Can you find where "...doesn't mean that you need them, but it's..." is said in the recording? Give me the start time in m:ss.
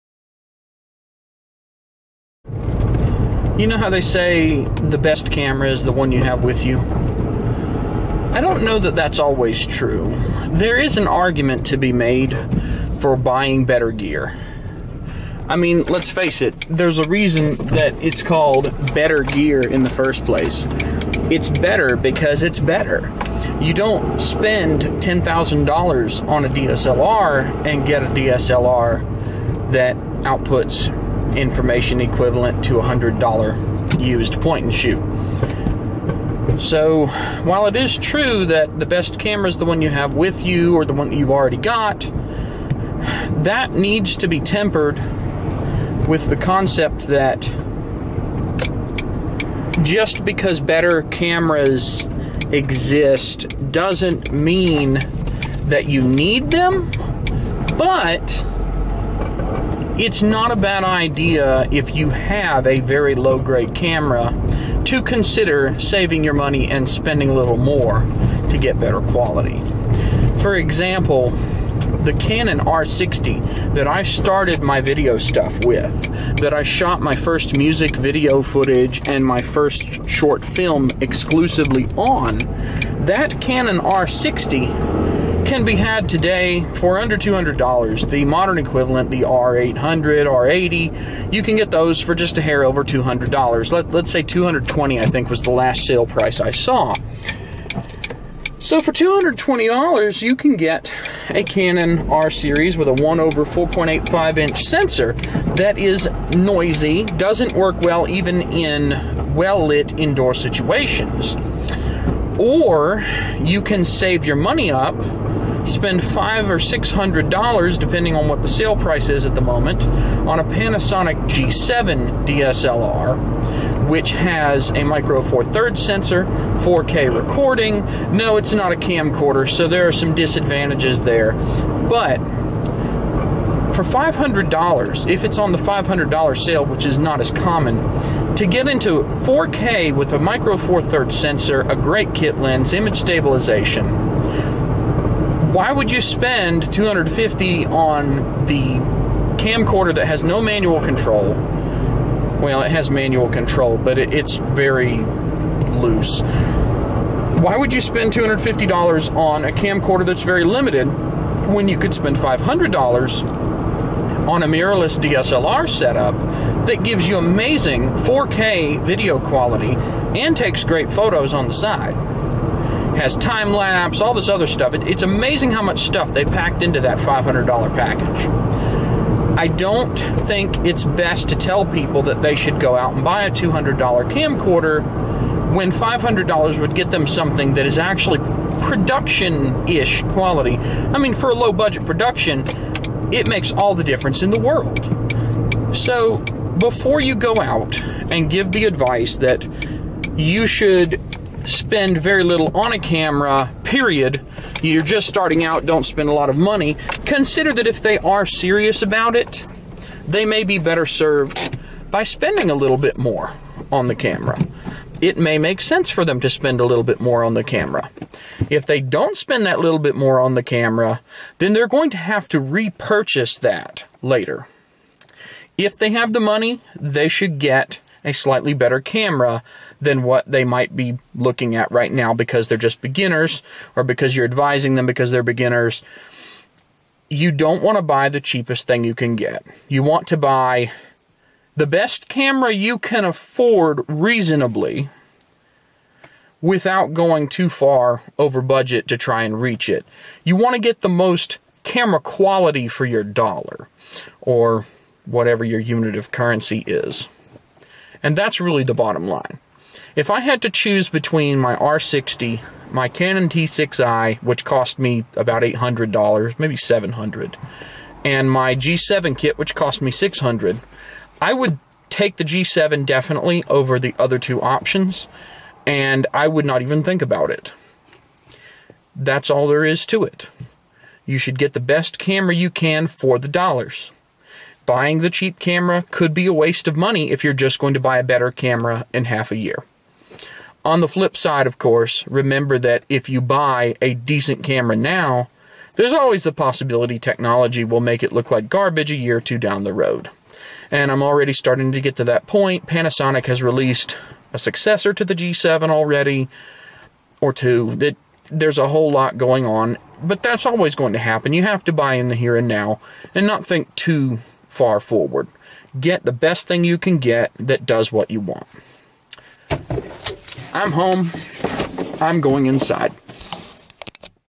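0:53.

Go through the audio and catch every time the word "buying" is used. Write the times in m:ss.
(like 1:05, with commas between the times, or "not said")
0:13, 4:44.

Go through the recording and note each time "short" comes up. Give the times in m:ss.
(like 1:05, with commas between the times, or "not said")
1:20.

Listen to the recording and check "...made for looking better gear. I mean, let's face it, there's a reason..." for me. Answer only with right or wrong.
wrong.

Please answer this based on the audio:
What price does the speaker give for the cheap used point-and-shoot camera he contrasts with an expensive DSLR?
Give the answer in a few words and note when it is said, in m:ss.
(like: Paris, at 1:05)
$100, at 0:32.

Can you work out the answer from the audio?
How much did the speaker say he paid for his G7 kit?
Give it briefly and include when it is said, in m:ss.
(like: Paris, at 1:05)
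600, at 4:29.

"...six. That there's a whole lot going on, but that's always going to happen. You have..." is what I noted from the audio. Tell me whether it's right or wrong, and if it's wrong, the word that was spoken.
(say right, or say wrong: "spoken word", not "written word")
wrong: "two", not "six".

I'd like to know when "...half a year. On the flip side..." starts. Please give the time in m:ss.
4:49.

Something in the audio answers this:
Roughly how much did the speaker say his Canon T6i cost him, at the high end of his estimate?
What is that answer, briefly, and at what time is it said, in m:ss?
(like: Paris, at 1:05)
$800, at 4:25.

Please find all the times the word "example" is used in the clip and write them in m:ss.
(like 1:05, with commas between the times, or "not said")
1:10.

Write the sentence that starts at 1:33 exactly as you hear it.
Let, let's say 220 dollars I think was the last sale price I saw.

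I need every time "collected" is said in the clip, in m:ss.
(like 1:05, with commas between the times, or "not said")
not said.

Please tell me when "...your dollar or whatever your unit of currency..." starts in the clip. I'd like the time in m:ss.
4:12.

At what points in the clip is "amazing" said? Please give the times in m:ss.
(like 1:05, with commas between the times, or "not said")
2:47, 2:55.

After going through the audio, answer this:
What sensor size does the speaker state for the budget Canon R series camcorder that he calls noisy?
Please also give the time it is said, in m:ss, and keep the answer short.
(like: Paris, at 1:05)
1/4.85 inch, at 1:42.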